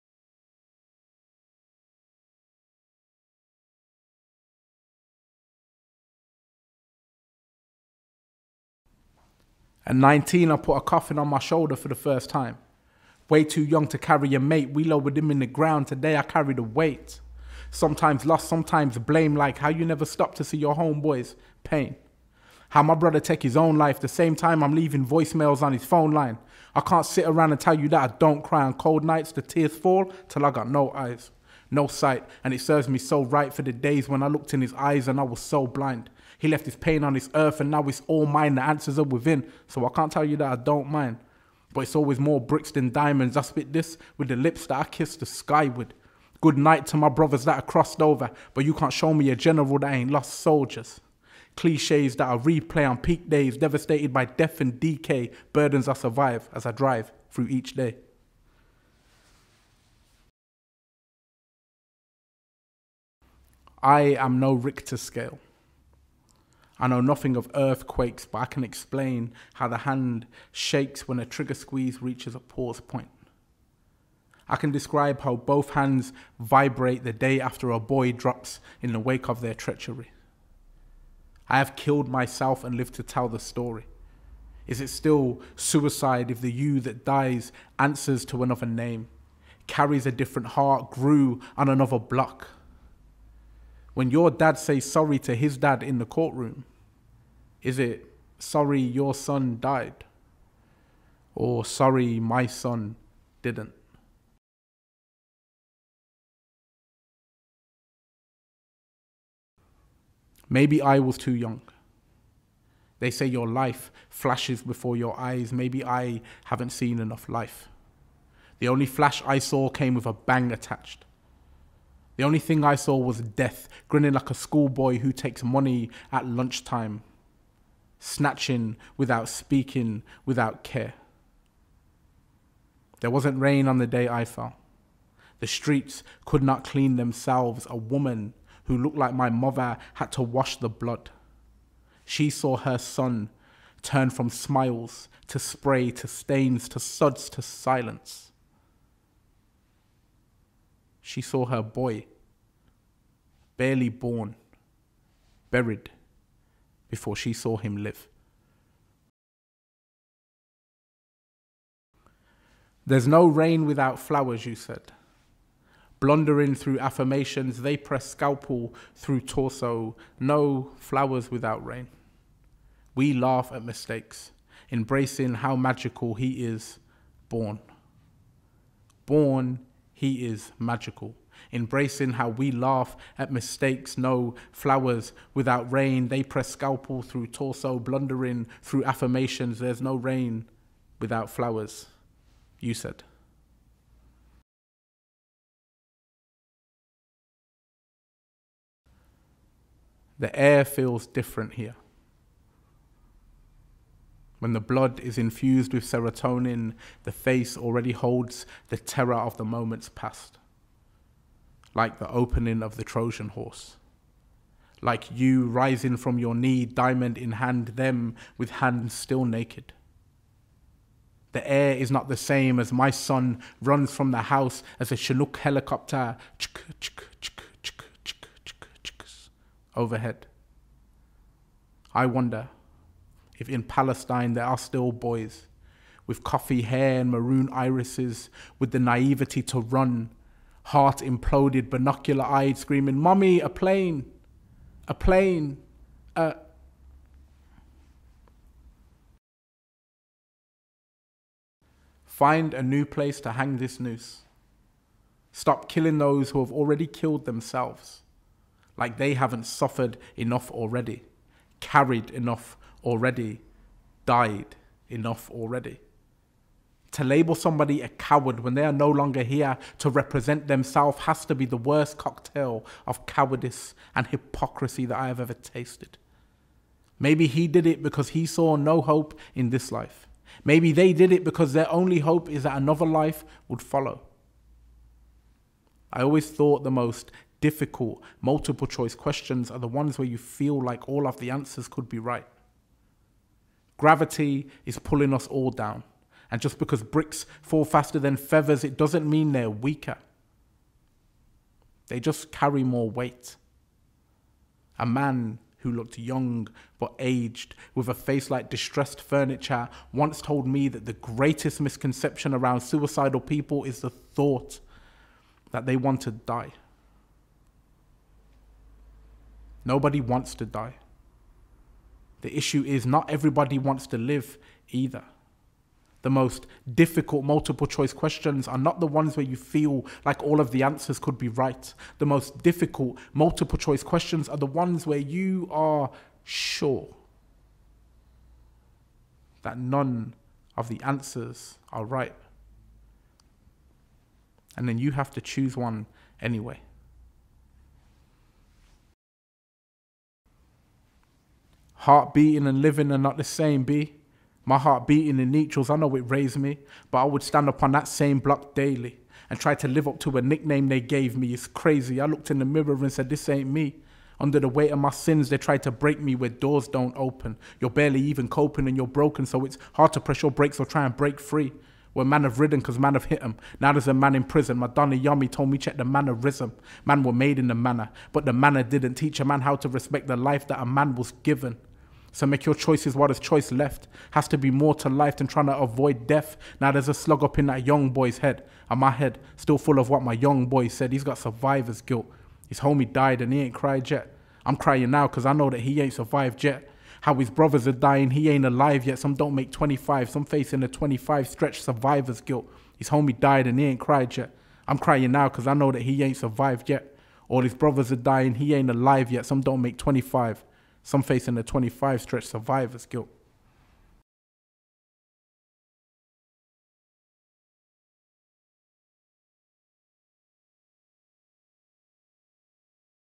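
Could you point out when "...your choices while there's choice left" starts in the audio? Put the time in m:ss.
6:22.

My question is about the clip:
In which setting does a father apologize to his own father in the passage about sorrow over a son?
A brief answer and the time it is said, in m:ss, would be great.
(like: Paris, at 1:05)
Courtroom, at 1:36.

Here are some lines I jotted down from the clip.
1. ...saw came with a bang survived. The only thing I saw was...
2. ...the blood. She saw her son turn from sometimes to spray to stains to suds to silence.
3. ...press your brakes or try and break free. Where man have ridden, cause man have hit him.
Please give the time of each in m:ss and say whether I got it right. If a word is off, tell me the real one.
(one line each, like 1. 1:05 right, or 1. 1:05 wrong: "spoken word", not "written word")
1. 1:59 wrong: "attached", not "survived"
2. 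2:20 wrong: "smiles", not "sometimes"
3. 6:09 right.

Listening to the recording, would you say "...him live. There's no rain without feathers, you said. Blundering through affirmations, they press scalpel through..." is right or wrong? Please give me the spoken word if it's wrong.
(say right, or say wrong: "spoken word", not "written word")
wrong: "flowers", not "feathers".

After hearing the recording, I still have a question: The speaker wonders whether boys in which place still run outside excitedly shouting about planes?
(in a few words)
Palestine.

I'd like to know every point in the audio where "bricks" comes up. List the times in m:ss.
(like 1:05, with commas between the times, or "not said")
0:42, 4:56.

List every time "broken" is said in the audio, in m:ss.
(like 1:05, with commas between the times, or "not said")
6:08.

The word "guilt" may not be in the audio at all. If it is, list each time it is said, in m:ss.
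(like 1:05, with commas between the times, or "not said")
6:31, 6:42, 6:52.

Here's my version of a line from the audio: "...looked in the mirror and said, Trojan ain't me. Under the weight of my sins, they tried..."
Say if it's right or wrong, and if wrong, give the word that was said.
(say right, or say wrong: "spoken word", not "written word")
wrong: "This", not "Trojan".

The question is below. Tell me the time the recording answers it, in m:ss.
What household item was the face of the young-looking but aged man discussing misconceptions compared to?
5:08.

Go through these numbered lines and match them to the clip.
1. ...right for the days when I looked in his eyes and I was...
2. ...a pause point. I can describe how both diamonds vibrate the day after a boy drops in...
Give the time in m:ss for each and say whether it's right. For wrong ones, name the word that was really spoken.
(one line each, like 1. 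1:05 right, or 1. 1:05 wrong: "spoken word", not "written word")
1. 0:33 right
2. 1:12 wrong: "hands", not "diamonds".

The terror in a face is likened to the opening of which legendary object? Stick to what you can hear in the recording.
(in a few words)
Trojan horse.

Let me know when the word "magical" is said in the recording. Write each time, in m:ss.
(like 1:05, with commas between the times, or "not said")
2:55, 3:00.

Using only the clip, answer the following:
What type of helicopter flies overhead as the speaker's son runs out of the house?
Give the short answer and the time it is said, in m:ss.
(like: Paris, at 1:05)
Chinook, at 3:44.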